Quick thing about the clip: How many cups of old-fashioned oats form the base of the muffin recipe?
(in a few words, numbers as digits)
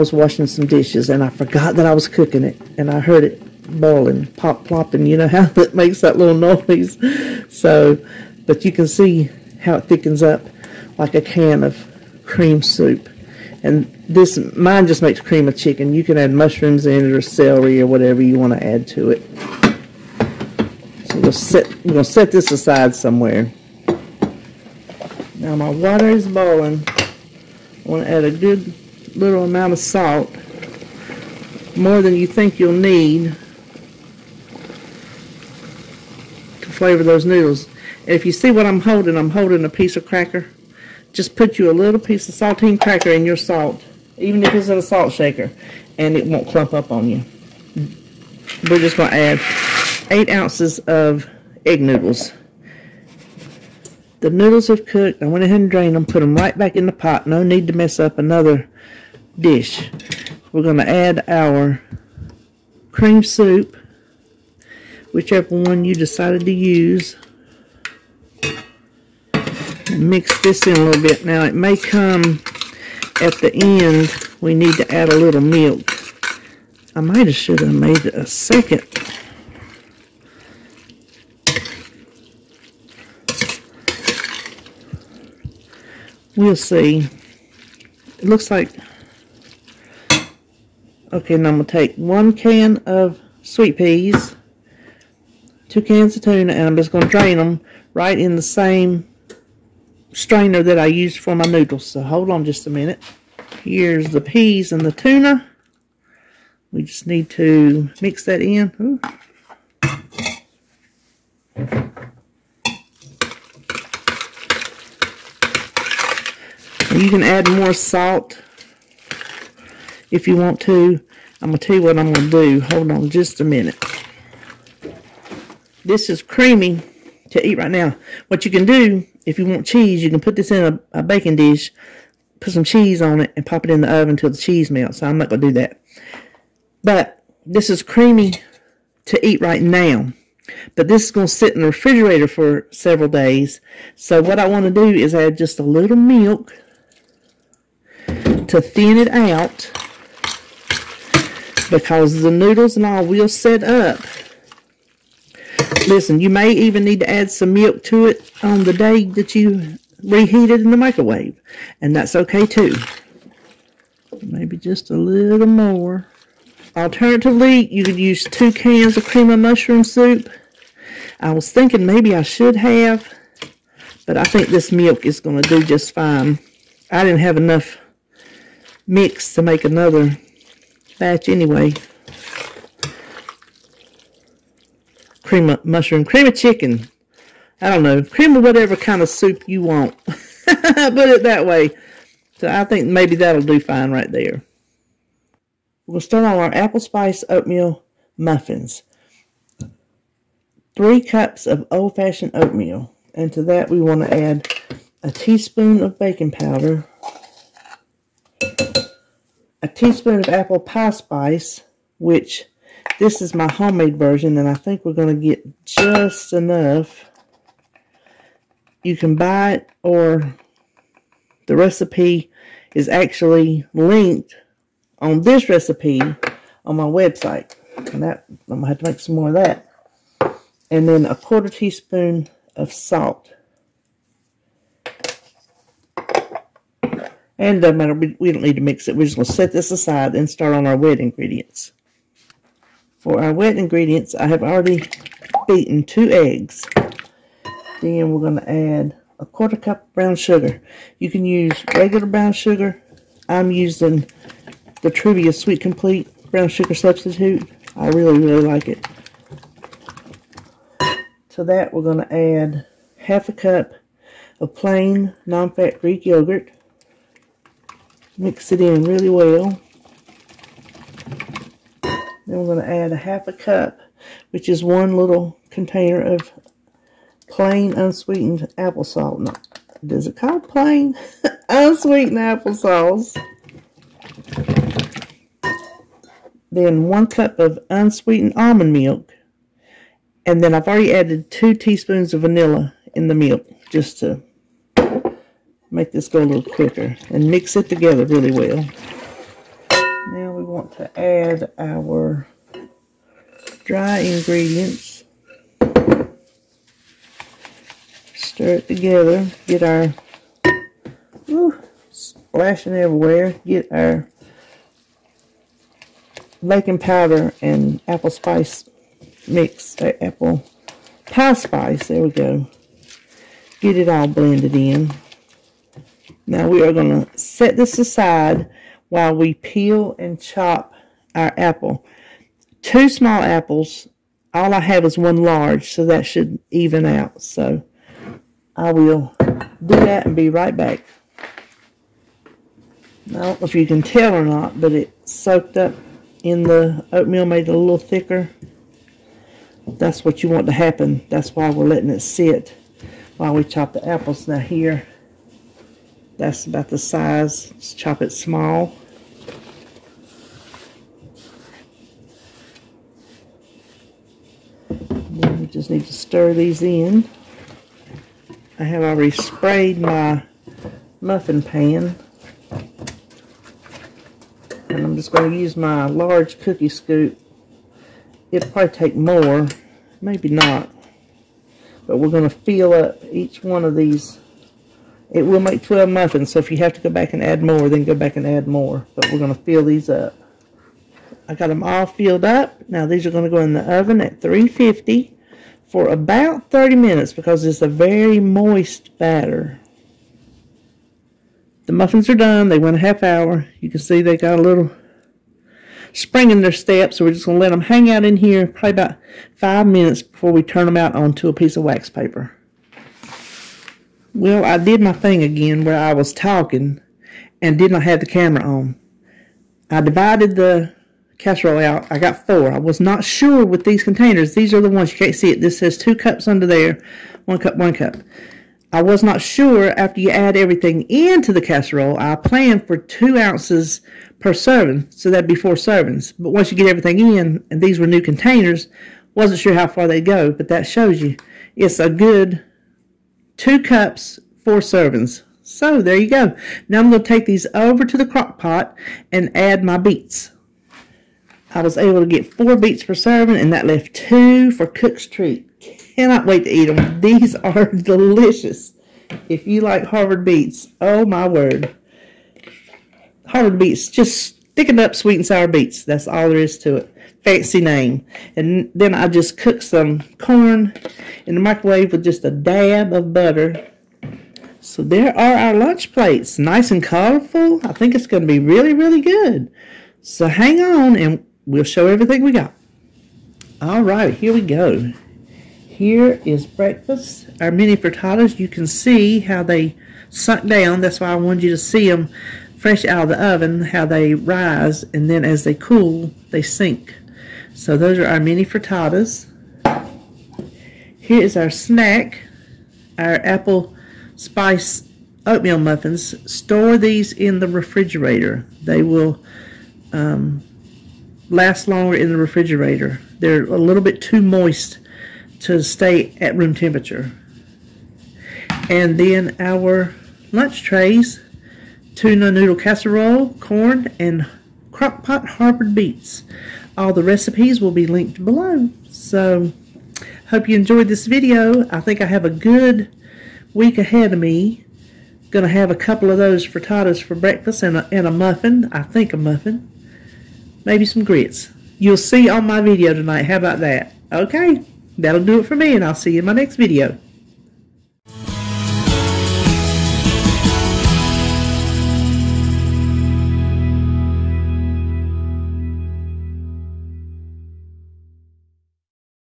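3.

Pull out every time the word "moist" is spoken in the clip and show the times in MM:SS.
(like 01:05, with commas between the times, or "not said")
06:38, 08:34.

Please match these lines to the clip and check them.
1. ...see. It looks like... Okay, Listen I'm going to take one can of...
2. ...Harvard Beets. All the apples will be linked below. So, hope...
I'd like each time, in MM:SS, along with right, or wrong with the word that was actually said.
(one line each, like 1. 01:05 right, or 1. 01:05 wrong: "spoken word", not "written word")
1. 01:26 wrong: "Now", not "Listen"
2. 08:45 wrong: "recipes", not "apples".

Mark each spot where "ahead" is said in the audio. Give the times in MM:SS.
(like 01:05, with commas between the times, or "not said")
00:55, 08:53.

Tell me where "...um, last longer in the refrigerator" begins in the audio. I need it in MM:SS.
08:29.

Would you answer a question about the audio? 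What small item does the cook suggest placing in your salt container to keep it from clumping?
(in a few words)
saltine cracker.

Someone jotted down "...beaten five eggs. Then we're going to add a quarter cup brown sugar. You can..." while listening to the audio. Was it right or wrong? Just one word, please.
wrong.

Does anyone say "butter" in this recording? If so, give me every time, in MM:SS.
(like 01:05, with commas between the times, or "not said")
07:53.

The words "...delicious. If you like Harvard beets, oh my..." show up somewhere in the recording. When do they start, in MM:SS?
07:37.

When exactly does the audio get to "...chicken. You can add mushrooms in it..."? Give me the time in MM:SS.
00:15.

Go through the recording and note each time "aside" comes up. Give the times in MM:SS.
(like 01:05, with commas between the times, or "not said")
00:22, 03:59, 05:27.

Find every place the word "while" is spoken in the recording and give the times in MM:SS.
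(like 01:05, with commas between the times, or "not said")
05:28, 05:53.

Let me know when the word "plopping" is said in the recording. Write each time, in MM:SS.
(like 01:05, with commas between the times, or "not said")
00:04.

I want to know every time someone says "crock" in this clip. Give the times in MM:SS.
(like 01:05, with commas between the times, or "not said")
07:28, 08:44.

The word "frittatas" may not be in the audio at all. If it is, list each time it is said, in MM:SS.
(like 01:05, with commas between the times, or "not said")
08:07, 08:18, 08:56.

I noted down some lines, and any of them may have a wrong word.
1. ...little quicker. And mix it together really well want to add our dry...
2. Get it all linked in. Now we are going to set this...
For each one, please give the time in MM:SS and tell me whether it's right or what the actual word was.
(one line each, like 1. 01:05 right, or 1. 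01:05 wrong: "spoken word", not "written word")
1. 04:56 right
2. 05:23 wrong: "blended", not "linked".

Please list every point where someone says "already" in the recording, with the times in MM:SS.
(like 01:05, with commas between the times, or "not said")
04:04, 04:50, 06:08.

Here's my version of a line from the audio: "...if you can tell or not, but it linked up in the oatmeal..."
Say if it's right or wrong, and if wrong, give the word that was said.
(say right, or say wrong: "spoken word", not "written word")
wrong: "soaked", not "linked".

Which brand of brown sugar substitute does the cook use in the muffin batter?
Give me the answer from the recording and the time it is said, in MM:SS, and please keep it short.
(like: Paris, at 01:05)
Truvia Sweet Complete, at 04:14.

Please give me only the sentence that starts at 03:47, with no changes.
And that I'm going to have to make some more of that.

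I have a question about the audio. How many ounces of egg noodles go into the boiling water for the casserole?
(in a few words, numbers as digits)
8.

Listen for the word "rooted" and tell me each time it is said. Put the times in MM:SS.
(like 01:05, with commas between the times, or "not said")
not said.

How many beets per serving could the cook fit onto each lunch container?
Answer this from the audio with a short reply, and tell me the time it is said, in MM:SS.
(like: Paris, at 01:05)
4, at 07:32.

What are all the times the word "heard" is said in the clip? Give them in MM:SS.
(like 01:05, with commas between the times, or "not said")
00:03.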